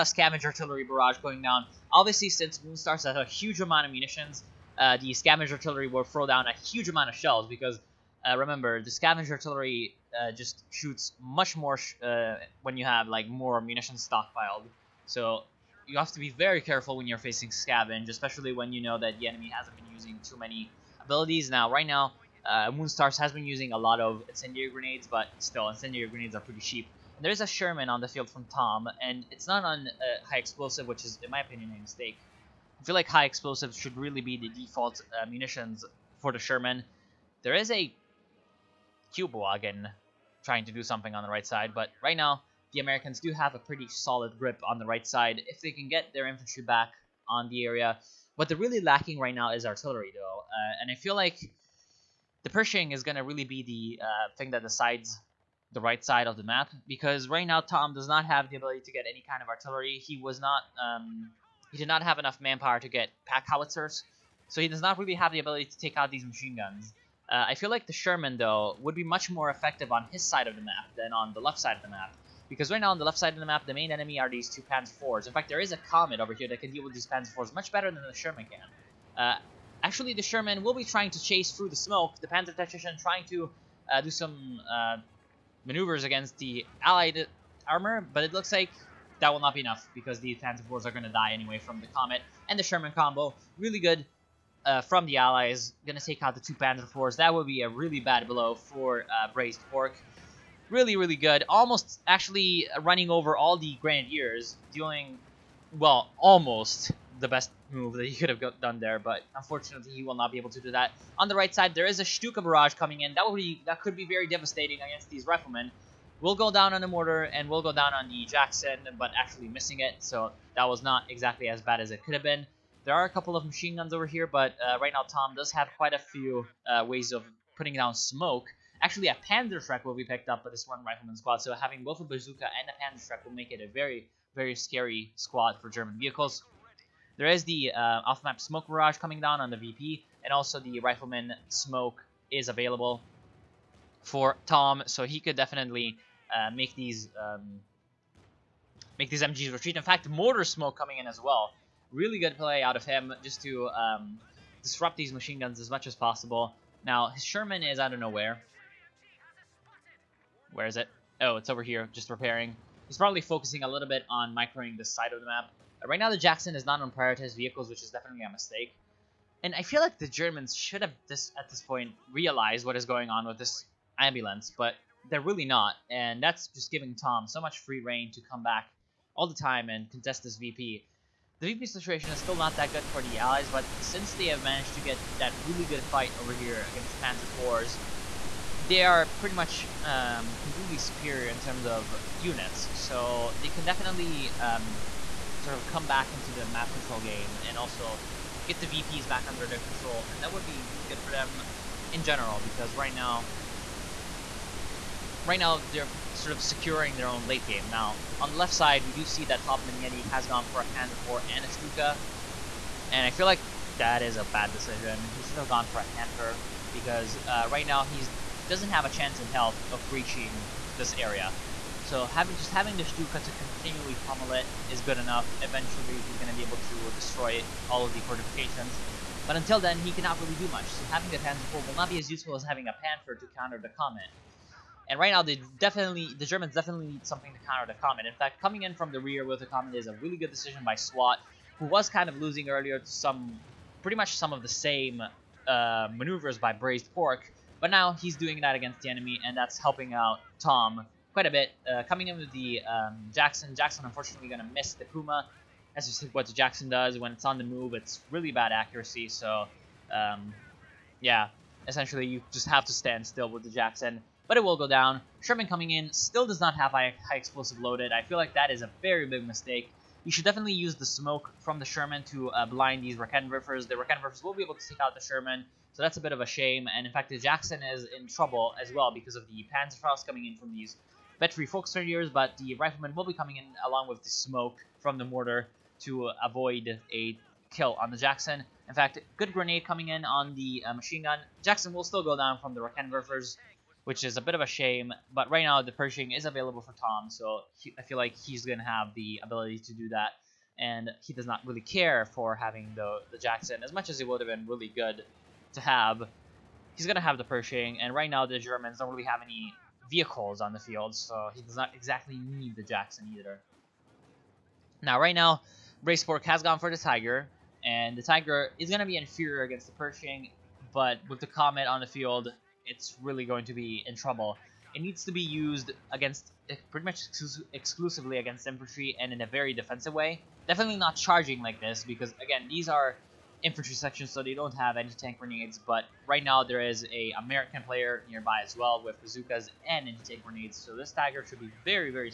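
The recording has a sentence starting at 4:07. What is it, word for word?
But now he's doing that against the enemy, and that's helping out Tom quite a bit.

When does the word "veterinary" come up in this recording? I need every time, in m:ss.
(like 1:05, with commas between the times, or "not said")
4:41.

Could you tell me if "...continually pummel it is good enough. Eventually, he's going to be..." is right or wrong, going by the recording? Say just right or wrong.
right.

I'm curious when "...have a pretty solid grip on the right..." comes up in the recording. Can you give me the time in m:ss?
0:43.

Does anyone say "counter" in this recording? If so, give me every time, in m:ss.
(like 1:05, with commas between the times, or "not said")
3:53, 3:57.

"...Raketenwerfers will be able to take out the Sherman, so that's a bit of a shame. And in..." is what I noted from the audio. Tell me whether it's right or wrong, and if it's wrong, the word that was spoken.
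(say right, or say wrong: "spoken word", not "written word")
right.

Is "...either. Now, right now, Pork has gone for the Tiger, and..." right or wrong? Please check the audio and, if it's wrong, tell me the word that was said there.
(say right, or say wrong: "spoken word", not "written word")
wrong: "Raceborg", not "Pork".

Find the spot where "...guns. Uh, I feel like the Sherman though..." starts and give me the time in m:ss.
1:06.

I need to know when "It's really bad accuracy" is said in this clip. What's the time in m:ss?
4:17.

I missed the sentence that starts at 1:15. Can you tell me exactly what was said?
In fact, there is a Comet over here that can deal with these Panzer IVs much better than the Sherman can.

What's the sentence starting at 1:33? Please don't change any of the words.
Really good uh, from the Allies.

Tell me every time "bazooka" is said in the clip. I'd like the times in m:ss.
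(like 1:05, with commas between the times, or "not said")
2:12, 5:39.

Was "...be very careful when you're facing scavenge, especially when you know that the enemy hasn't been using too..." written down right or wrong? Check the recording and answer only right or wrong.
right.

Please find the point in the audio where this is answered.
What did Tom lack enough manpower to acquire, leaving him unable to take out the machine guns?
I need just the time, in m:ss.
1:03.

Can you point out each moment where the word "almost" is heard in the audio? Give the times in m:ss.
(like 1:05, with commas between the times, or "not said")
1:41, 1:46.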